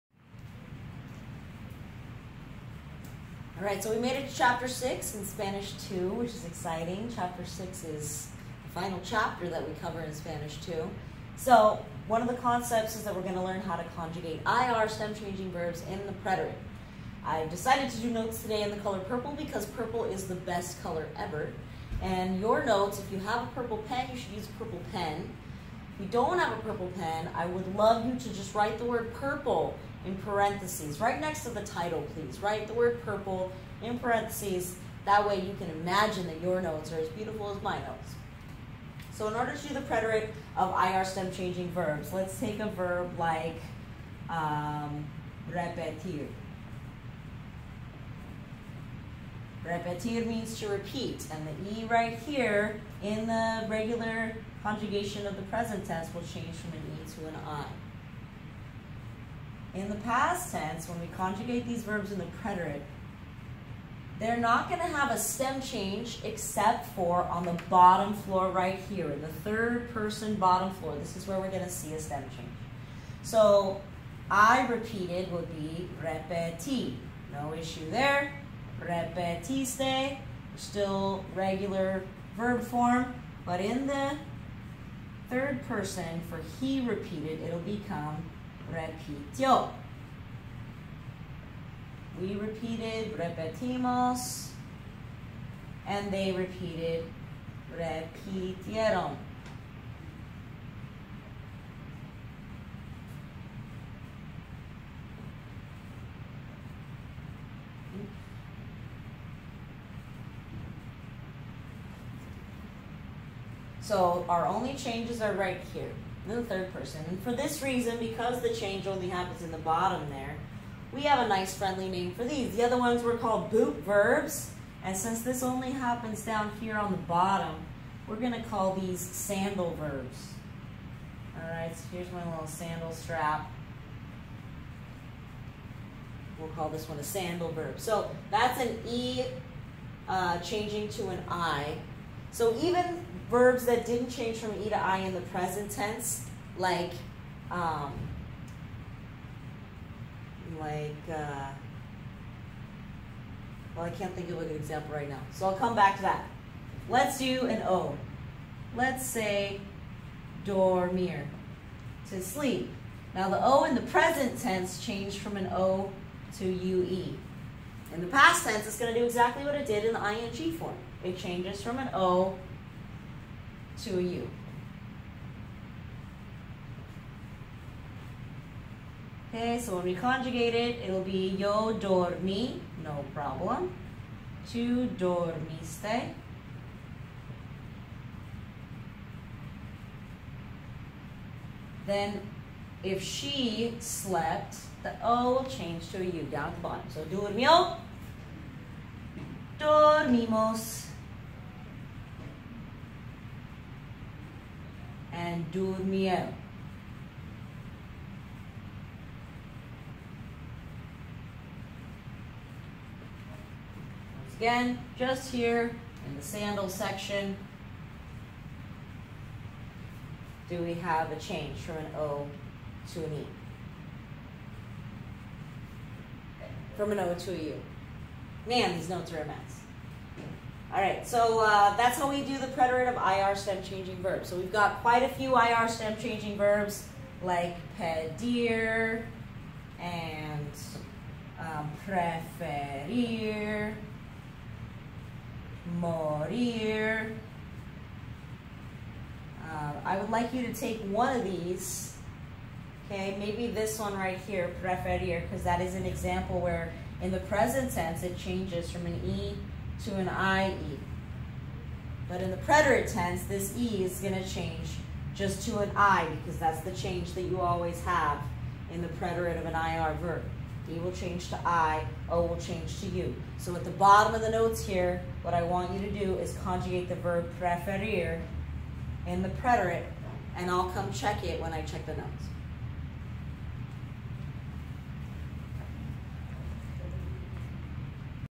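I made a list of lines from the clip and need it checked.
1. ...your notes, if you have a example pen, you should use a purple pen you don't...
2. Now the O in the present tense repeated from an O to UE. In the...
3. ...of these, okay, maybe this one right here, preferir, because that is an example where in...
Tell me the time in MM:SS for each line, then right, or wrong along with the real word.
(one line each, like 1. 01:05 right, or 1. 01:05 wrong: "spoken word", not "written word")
1. 00:22 wrong: "purple", not "example"
2. 02:43 wrong: "changed", not "repeated"
3. 04:11 right.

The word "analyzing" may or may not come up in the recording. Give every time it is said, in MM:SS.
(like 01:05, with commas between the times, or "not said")
not said.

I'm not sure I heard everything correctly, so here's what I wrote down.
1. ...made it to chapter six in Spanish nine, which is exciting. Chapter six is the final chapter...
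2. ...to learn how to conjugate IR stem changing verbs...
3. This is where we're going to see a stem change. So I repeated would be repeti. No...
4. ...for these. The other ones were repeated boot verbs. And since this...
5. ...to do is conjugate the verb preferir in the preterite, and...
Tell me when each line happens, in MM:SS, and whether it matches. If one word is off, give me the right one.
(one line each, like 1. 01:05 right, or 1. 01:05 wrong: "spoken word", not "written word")
1. 00:03 wrong: "two", not "nine"
2. 00:13 right
3. 01:10 right
4. 02:02 wrong: "called", not "repeated"
5. 04:35 right.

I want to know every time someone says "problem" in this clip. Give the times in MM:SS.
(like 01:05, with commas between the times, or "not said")
03:03.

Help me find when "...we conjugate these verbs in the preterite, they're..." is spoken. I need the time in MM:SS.
01:00.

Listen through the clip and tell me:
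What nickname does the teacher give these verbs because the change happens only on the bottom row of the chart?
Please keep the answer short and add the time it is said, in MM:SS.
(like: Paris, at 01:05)
sandal verbs, at 02:09.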